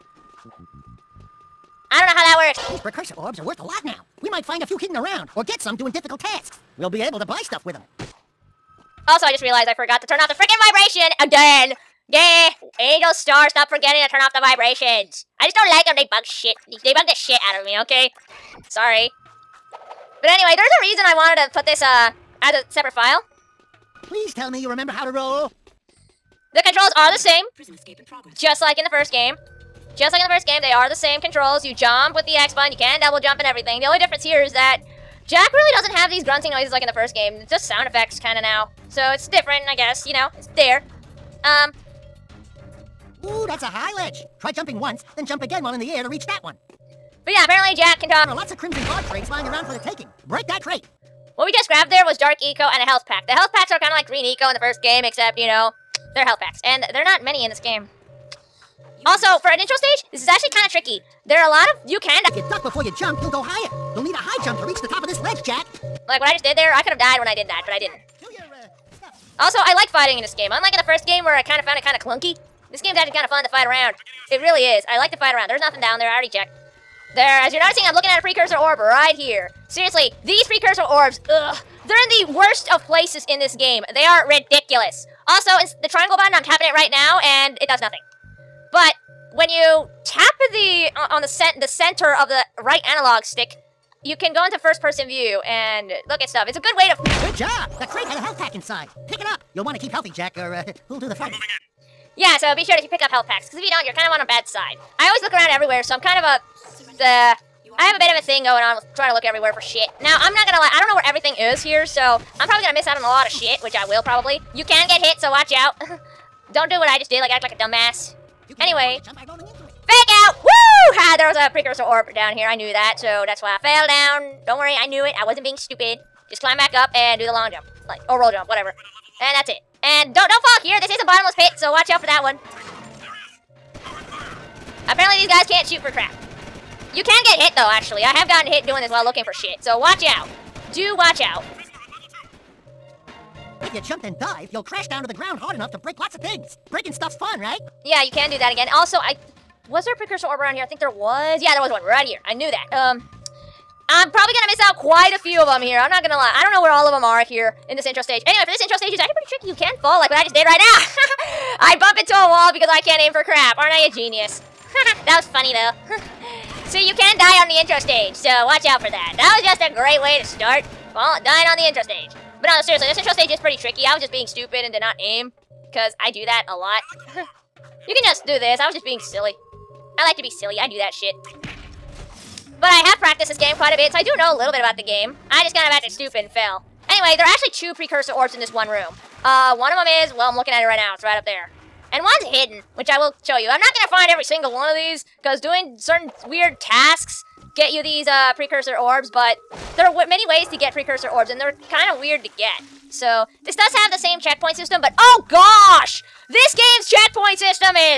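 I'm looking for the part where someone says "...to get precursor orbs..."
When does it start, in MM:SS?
03:20.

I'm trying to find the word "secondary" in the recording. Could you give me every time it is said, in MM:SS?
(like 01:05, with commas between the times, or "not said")
not said.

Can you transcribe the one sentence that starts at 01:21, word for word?
They're in the worst of places in this game.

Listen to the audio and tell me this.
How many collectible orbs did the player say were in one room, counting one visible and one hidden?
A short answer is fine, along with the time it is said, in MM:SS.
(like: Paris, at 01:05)
2, at 03:07.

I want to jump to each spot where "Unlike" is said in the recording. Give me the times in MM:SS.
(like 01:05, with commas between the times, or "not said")
01:10.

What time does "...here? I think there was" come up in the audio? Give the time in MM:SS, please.
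02:30.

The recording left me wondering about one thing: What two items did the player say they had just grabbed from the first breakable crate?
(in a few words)
Dark Eco and a health pack.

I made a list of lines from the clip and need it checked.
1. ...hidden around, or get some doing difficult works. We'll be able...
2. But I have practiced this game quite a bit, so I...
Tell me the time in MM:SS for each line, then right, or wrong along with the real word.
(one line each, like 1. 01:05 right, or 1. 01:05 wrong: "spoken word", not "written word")
1. 00:04 wrong: "tasks", not "works"
2. 03:02 right.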